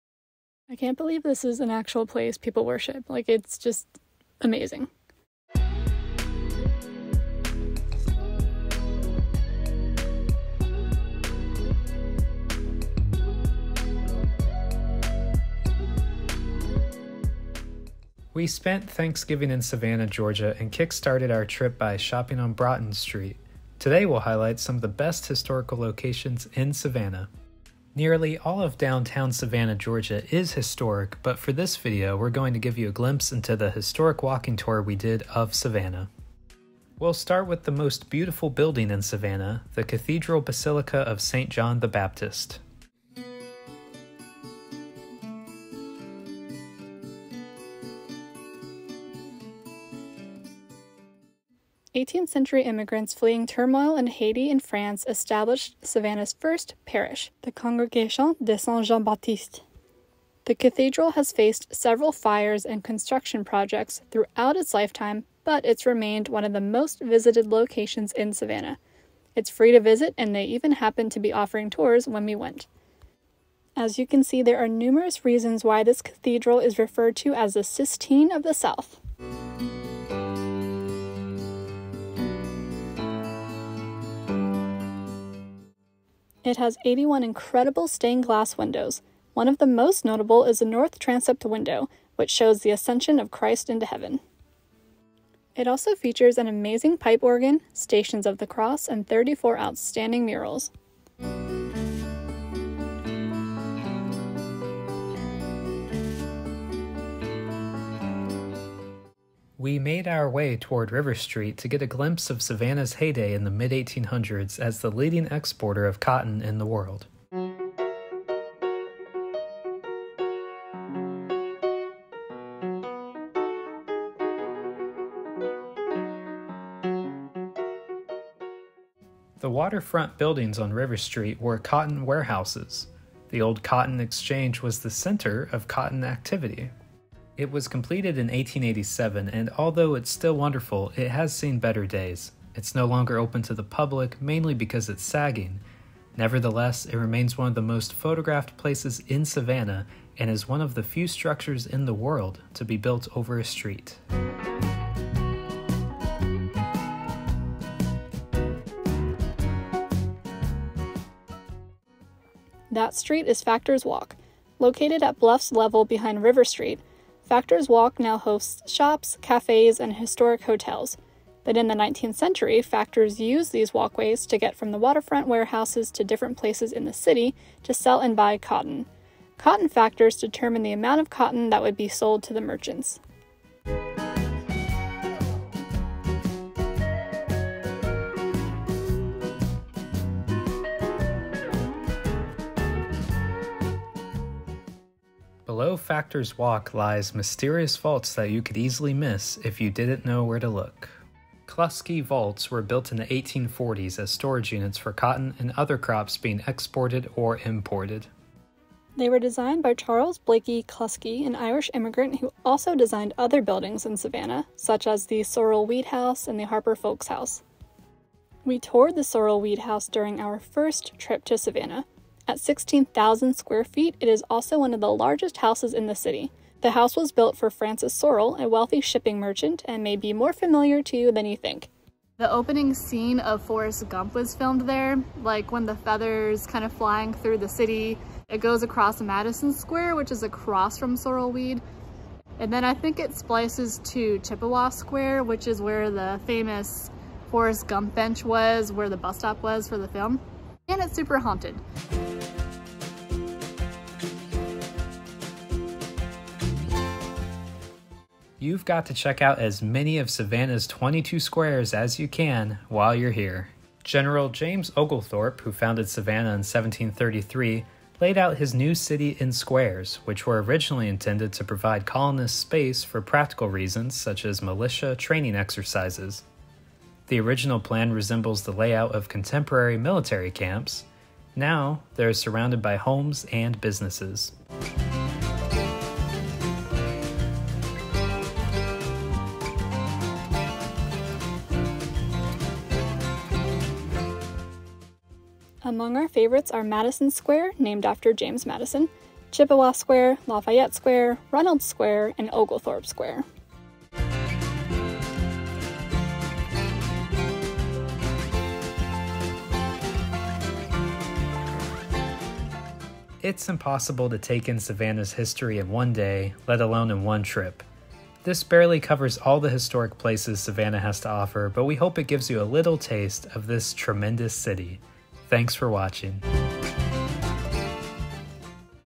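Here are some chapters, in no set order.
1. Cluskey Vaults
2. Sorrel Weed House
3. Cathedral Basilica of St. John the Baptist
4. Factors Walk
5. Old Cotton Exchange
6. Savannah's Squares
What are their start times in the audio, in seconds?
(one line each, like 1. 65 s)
1. 194 s
2. 218 s
3. 36 s
4. 162 s
5. 109 s
6. 260 s.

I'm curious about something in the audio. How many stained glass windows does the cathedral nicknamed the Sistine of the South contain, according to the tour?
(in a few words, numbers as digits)
81.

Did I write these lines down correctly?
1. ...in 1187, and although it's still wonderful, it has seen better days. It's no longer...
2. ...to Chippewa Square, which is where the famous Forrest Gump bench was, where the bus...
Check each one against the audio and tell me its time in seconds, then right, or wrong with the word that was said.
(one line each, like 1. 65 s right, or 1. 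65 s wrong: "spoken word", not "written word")
1. 138 s wrong: "1887", not "1187"
2. 243 s right.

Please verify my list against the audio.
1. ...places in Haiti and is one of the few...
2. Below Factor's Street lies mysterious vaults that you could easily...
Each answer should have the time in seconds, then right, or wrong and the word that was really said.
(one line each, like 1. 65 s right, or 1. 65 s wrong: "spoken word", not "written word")
1. 148 s wrong: "Savannah", not "Haiti"
2. 195 s wrong: "Walk", not "Street".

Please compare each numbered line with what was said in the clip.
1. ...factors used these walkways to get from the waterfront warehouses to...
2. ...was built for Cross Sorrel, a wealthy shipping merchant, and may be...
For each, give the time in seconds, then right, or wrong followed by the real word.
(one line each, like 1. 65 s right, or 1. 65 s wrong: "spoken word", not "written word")
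1. 172 s right
2. 226 s wrong: "Francis", not "Cross".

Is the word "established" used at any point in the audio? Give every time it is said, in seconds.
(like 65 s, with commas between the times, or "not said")
55 s.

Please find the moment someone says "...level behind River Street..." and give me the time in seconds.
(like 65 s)
165 s.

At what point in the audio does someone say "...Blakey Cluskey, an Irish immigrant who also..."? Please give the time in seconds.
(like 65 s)
210 s.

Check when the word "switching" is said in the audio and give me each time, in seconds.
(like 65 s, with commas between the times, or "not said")
not said.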